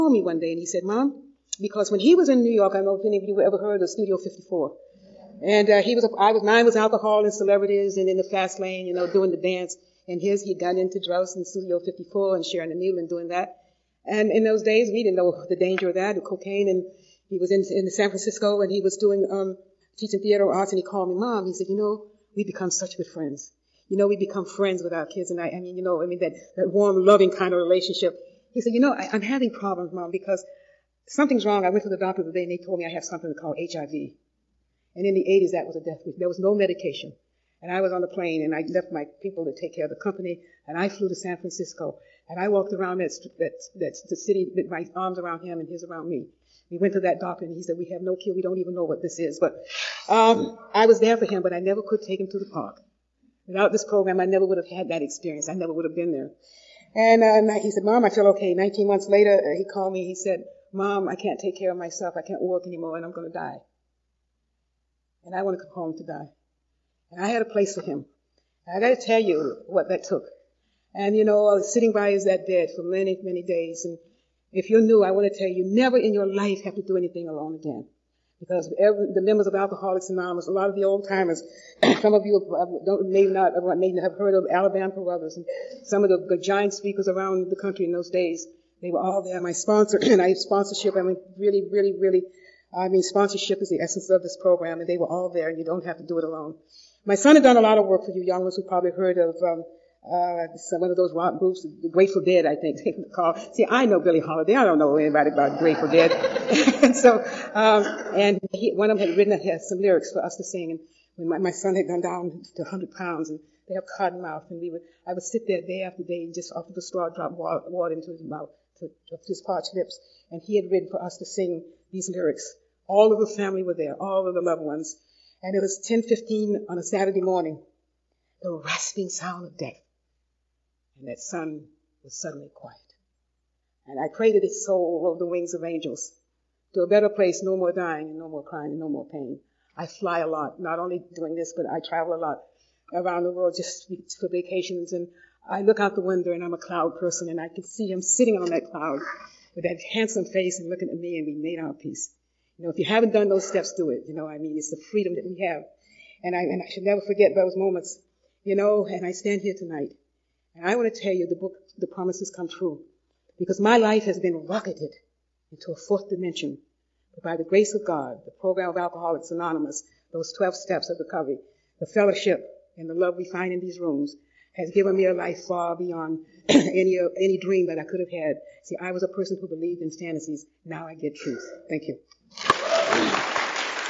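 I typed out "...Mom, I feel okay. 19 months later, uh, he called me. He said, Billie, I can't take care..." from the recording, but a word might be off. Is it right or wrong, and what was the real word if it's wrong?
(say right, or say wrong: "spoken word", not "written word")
wrong: "Mom", not "Billie".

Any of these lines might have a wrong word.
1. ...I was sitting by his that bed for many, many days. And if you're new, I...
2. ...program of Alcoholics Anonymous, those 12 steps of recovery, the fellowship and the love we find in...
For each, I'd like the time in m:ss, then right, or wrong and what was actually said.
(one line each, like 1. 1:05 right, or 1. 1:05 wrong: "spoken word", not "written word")
1. 1:11 right
2. 2:48 right.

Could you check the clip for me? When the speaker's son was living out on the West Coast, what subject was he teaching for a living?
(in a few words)
Theater arts.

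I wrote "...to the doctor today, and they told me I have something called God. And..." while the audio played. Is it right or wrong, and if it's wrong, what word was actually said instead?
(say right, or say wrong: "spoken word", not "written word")
wrong: "HIV", not "God".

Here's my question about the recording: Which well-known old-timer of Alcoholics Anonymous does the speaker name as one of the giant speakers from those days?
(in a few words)
Alabama Carruthers.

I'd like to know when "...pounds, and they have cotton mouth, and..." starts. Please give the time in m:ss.
1:52.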